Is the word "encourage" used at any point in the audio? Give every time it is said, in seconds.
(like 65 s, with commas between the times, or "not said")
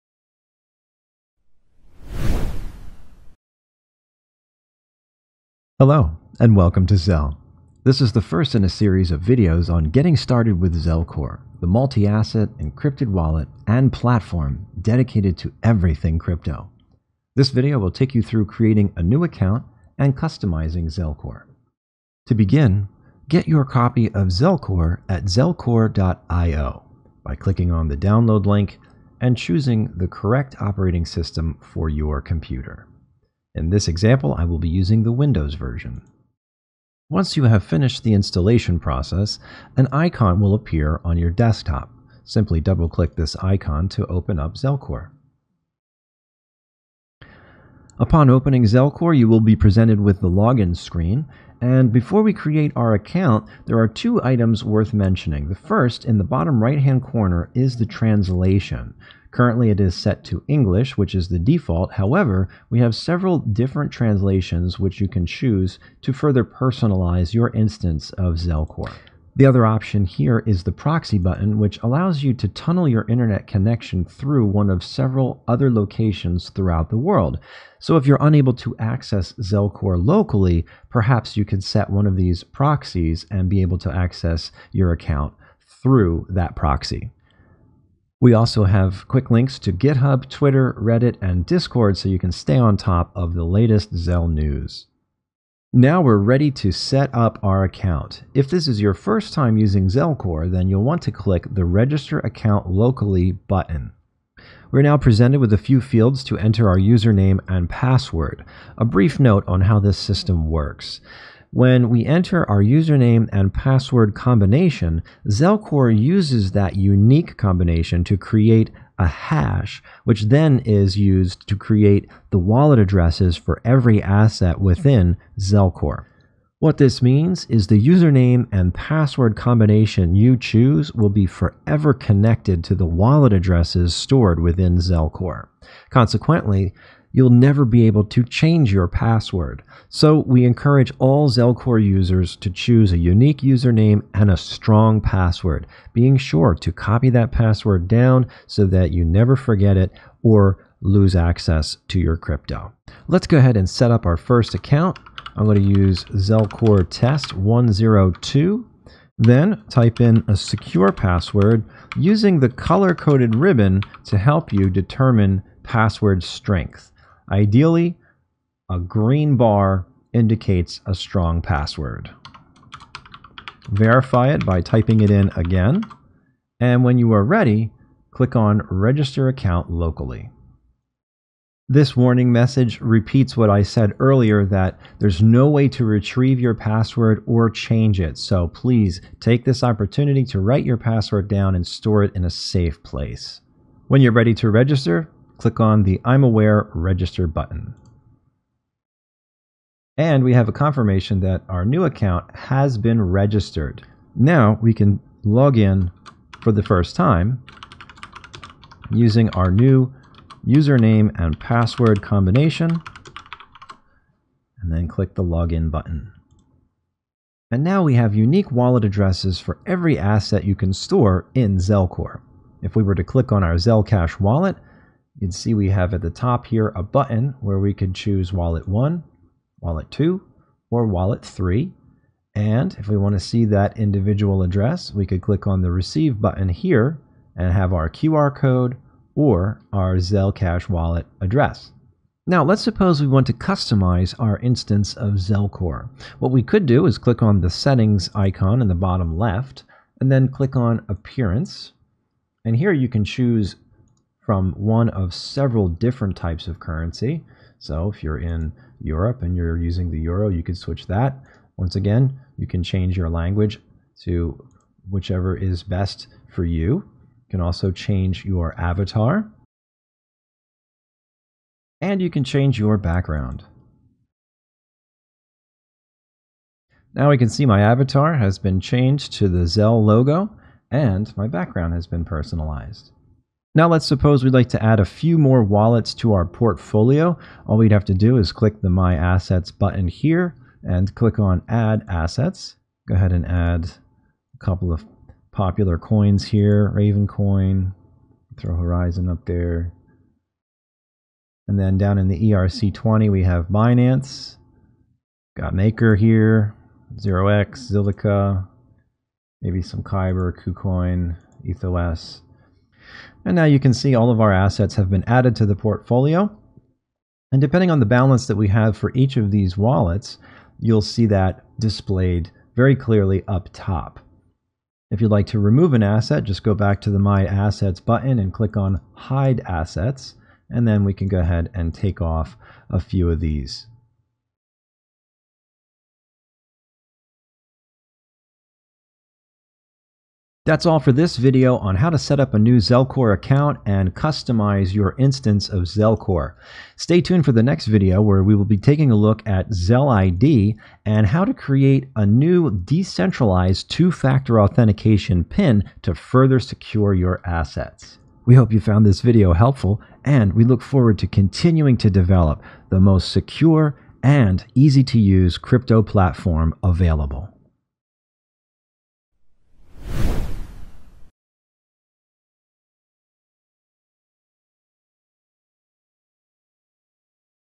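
140 s.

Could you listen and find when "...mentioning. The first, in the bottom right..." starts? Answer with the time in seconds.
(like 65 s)
54 s.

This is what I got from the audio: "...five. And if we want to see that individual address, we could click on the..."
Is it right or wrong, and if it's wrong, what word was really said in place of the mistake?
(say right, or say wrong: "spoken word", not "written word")
wrong: "three", not "five".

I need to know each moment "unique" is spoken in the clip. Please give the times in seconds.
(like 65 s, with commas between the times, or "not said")
116 s, 142 s, 218 s.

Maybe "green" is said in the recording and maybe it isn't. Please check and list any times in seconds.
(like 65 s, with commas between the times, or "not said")
168 s.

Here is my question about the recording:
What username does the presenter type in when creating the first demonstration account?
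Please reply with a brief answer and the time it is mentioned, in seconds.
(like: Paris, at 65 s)
Zelcore test 102, at 156 s.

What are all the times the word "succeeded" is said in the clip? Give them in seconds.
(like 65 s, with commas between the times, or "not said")
not said.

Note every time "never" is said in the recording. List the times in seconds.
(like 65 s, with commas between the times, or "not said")
137 s, 149 s.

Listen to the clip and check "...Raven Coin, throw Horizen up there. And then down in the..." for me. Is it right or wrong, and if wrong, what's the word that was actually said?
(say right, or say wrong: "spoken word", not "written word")
right.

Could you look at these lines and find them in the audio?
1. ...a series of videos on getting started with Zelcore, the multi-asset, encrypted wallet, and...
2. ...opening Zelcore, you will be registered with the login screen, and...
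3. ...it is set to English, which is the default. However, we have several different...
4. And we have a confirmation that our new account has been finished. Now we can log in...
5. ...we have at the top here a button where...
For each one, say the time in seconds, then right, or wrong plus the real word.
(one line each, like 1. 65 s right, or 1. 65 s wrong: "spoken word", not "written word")
1. 8 s right
2. 48 s wrong: "presented", not "registered"
3. 59 s right
4. 199 s wrong: "registered", not "finished"
5. 225 s right.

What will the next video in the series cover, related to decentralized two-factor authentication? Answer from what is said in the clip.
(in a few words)
ZelID.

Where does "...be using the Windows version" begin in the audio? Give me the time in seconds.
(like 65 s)
34 s.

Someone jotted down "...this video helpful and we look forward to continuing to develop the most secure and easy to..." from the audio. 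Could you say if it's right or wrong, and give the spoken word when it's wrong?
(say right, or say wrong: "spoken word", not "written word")
right.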